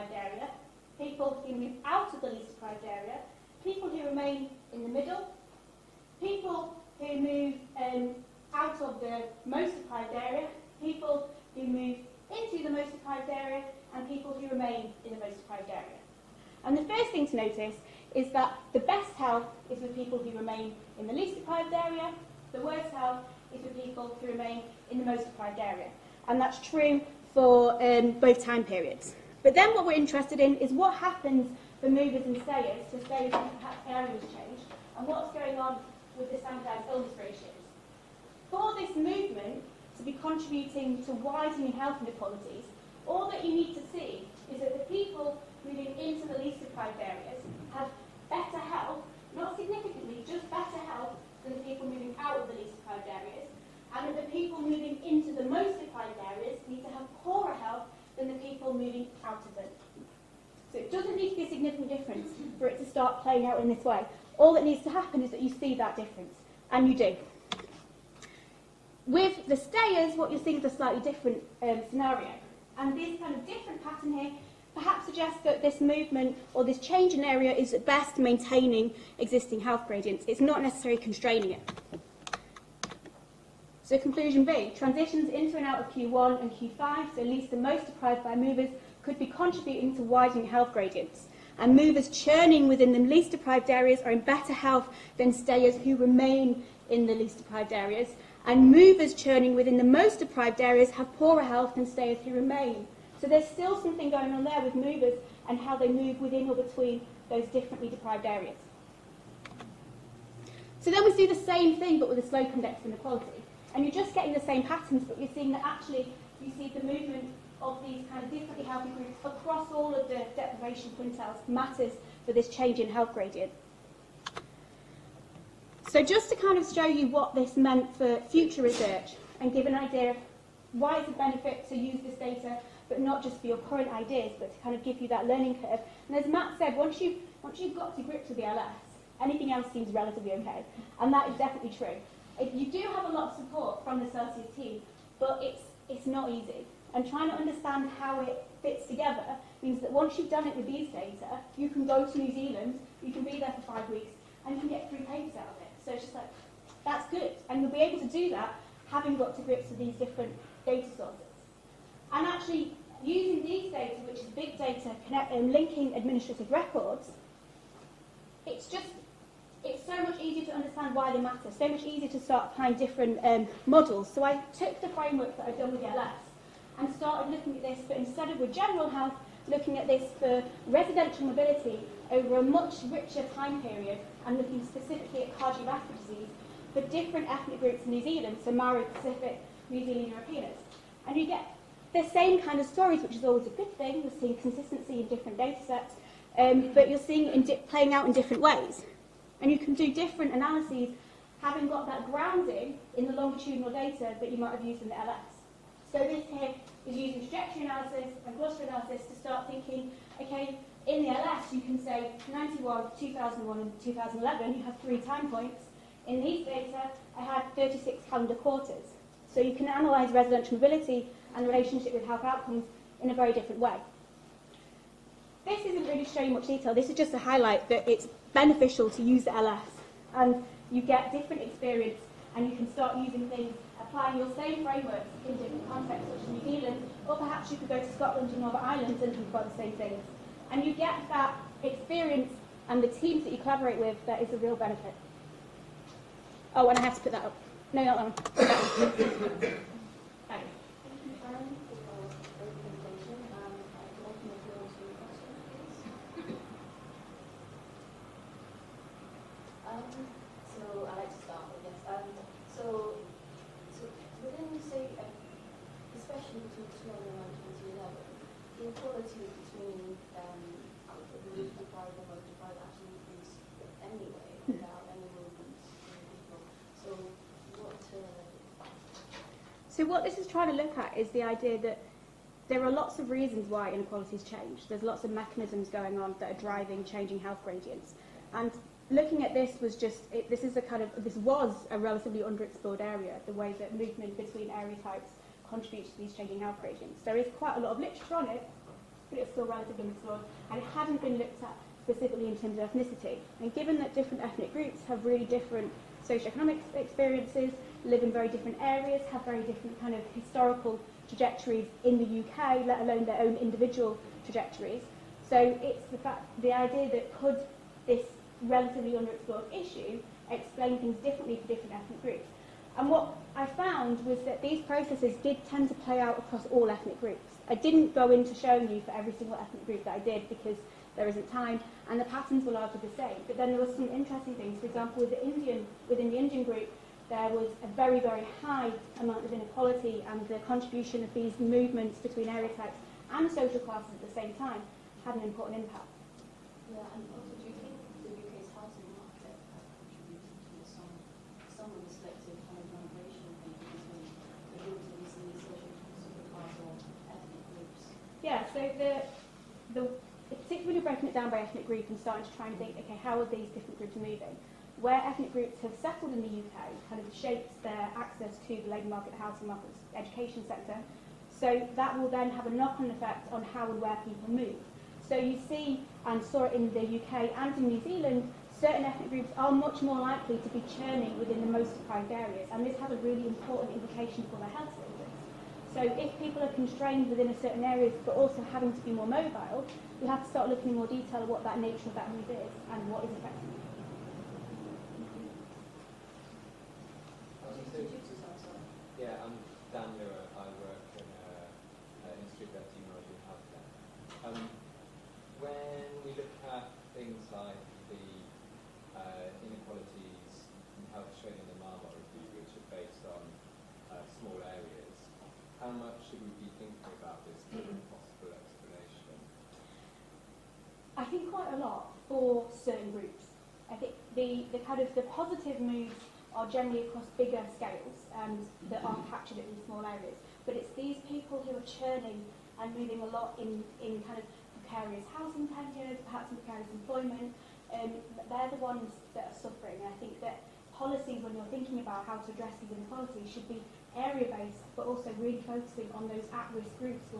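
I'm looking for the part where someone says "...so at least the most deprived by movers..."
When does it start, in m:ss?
1:27.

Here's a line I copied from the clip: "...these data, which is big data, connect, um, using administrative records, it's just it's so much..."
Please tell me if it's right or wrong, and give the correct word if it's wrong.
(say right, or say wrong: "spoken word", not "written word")
wrong: "linking", not "using".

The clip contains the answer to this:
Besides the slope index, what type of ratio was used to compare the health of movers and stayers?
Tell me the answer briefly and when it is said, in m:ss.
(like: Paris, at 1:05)
Standardised illness ratios, at 0:36.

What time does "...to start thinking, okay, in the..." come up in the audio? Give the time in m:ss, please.
3:29.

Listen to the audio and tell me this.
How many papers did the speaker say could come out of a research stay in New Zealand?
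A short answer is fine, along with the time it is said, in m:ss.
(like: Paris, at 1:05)
3, at 2:34.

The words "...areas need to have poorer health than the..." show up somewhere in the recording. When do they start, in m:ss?
0:56.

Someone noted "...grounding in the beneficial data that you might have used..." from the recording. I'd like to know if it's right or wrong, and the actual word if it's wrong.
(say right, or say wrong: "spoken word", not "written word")
wrong: "longitudinal", not "beneficial".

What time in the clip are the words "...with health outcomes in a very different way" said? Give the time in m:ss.
3:41.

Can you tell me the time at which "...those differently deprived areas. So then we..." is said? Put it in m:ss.
1:47.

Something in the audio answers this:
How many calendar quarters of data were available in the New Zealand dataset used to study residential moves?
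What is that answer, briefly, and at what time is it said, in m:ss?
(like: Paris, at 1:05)
36, at 3:37.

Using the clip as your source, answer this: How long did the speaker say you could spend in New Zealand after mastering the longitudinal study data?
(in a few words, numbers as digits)
5 weeks.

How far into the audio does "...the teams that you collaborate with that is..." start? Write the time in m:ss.
4:02.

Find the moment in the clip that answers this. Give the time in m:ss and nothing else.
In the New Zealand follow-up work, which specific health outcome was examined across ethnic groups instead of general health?
3:05.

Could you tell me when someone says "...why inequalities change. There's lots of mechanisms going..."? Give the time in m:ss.
4:43.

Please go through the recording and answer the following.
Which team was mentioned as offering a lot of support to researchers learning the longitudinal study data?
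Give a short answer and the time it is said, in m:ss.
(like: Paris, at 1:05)
CeLSIUS, at 2:24.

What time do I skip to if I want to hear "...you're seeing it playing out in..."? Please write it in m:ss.
3:16.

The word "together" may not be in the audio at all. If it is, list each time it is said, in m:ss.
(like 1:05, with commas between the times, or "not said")
2:28.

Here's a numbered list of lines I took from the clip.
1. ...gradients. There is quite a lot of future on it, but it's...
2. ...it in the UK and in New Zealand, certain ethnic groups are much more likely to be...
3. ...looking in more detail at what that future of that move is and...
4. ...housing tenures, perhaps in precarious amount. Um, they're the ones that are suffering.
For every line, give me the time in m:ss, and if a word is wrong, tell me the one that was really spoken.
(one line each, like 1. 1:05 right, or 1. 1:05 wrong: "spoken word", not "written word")
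1. 4:56 wrong: "literature", not "future"
2. 6:16 right
3. 6:30 wrong: "nature", not "future"
4. 7:15 wrong: "employment", not "amount".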